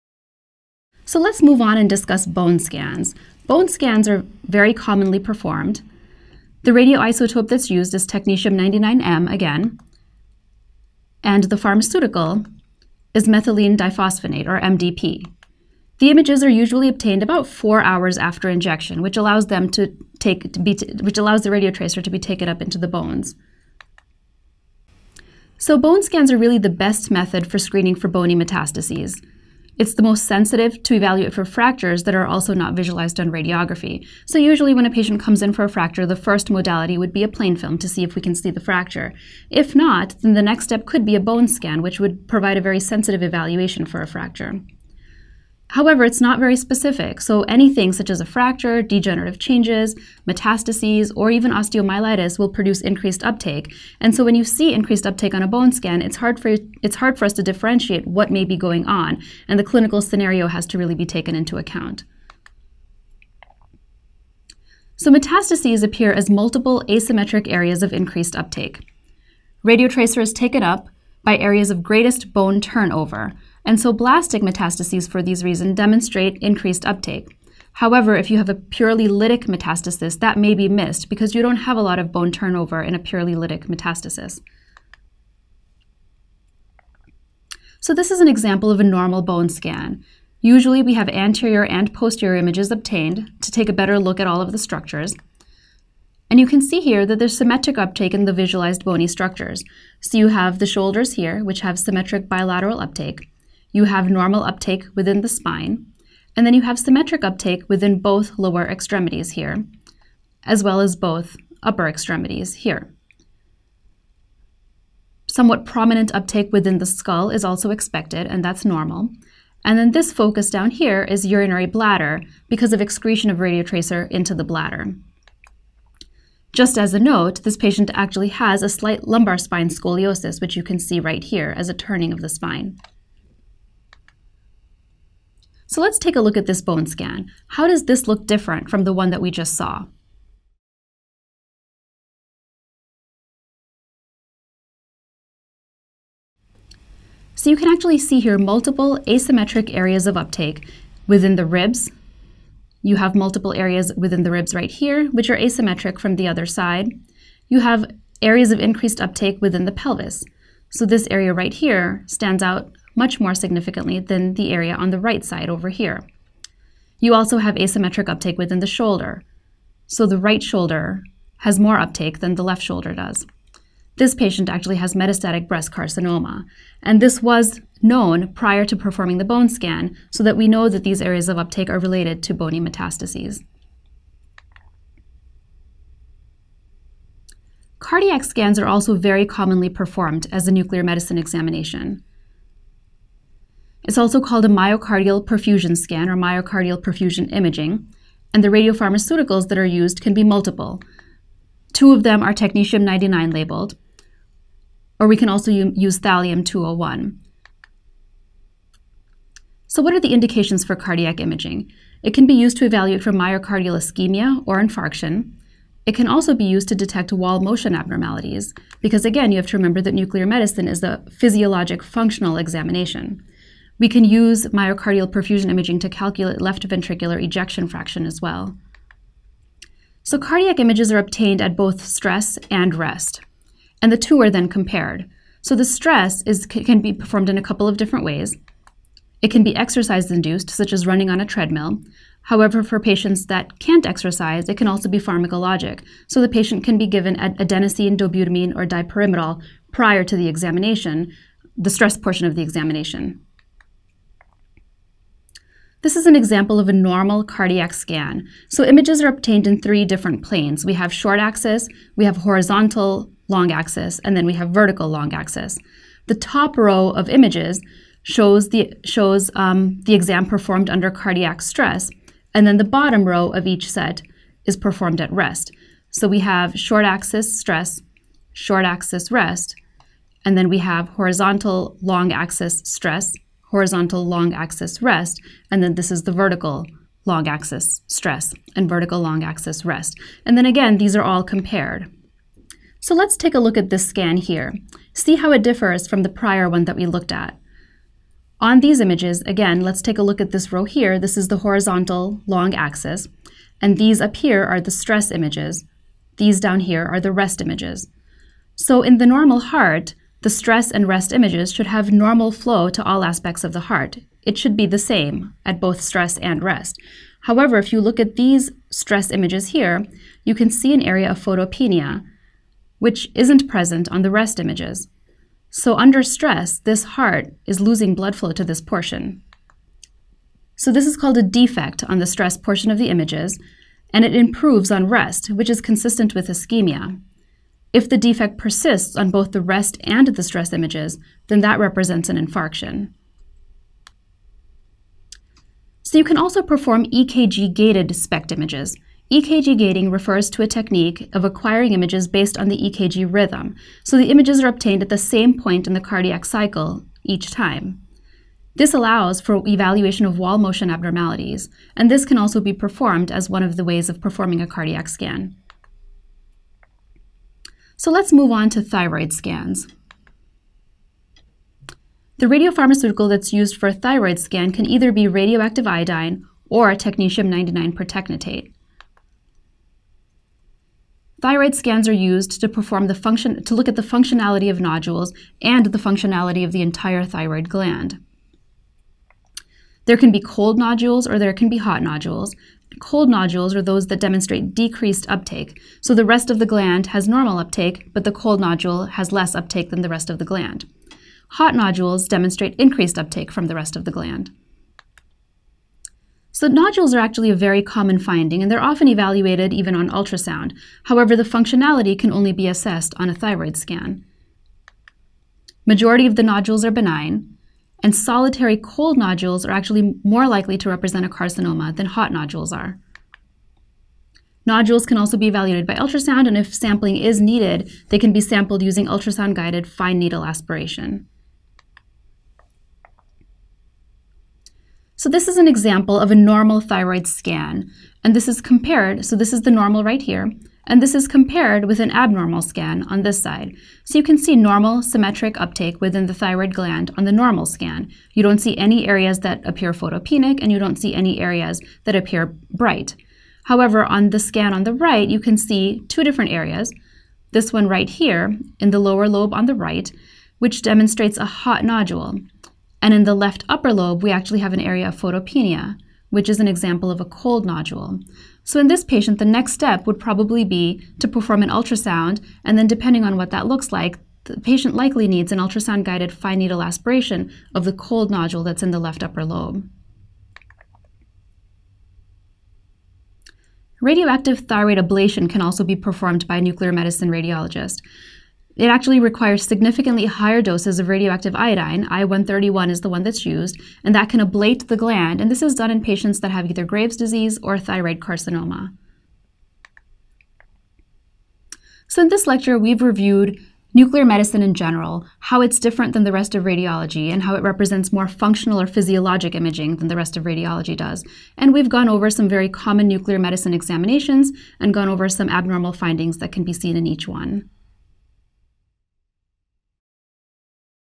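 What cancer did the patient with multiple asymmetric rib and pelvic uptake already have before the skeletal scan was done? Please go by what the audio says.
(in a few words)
Metastatic breast carcinoma.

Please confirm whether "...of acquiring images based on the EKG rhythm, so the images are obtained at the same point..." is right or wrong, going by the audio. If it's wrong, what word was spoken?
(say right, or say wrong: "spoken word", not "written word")
right.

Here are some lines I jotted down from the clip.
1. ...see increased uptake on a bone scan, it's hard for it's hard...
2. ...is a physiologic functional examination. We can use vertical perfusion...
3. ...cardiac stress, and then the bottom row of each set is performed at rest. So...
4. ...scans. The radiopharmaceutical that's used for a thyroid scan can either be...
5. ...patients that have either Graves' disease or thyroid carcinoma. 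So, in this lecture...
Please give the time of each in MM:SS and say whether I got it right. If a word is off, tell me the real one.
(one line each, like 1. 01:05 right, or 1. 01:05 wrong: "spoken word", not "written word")
1. 00:54 right
2. 03:40 wrong: "myocardial", not "vertical"
3. 04:30 right
4. 06:09 right
5. 08:15 right.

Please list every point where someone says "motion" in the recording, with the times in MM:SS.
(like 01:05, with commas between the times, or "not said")
03:37, 06:00.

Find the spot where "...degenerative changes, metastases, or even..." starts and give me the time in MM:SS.
00:48.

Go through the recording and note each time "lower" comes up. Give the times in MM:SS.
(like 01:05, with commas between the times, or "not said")
01:48, 07:38.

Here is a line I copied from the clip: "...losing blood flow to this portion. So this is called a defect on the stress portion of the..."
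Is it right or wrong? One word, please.
right.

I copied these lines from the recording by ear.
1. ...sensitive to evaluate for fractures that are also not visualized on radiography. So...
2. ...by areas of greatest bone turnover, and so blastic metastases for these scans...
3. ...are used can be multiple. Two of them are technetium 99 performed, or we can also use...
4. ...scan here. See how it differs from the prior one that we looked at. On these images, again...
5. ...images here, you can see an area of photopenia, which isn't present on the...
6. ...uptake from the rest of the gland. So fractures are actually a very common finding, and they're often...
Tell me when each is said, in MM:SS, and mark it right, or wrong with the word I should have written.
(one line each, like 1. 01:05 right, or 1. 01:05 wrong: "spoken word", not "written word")
1. 00:30 right
2. 01:11 wrong: "reasons", not "scans"
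3. 03:19 wrong: "labeled", not "performed"
4. 04:53 right
5. 05:19 right
6. 06:42 wrong: "nodules", not "fractures".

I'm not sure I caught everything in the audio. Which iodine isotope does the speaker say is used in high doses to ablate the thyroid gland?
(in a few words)
I 131.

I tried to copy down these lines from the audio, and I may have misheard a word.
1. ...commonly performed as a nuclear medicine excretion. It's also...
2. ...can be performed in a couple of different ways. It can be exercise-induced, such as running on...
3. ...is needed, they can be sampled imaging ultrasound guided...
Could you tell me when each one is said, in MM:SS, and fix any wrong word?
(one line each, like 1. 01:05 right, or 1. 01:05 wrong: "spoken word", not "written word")
1. 03:09 wrong: "examination", not "excretion"
2. 03:56 right
3. 07:06 wrong: "using", not "imaging".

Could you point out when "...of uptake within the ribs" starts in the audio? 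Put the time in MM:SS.
02:30.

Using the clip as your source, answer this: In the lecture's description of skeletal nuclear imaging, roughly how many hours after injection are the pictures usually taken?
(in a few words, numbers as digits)
4.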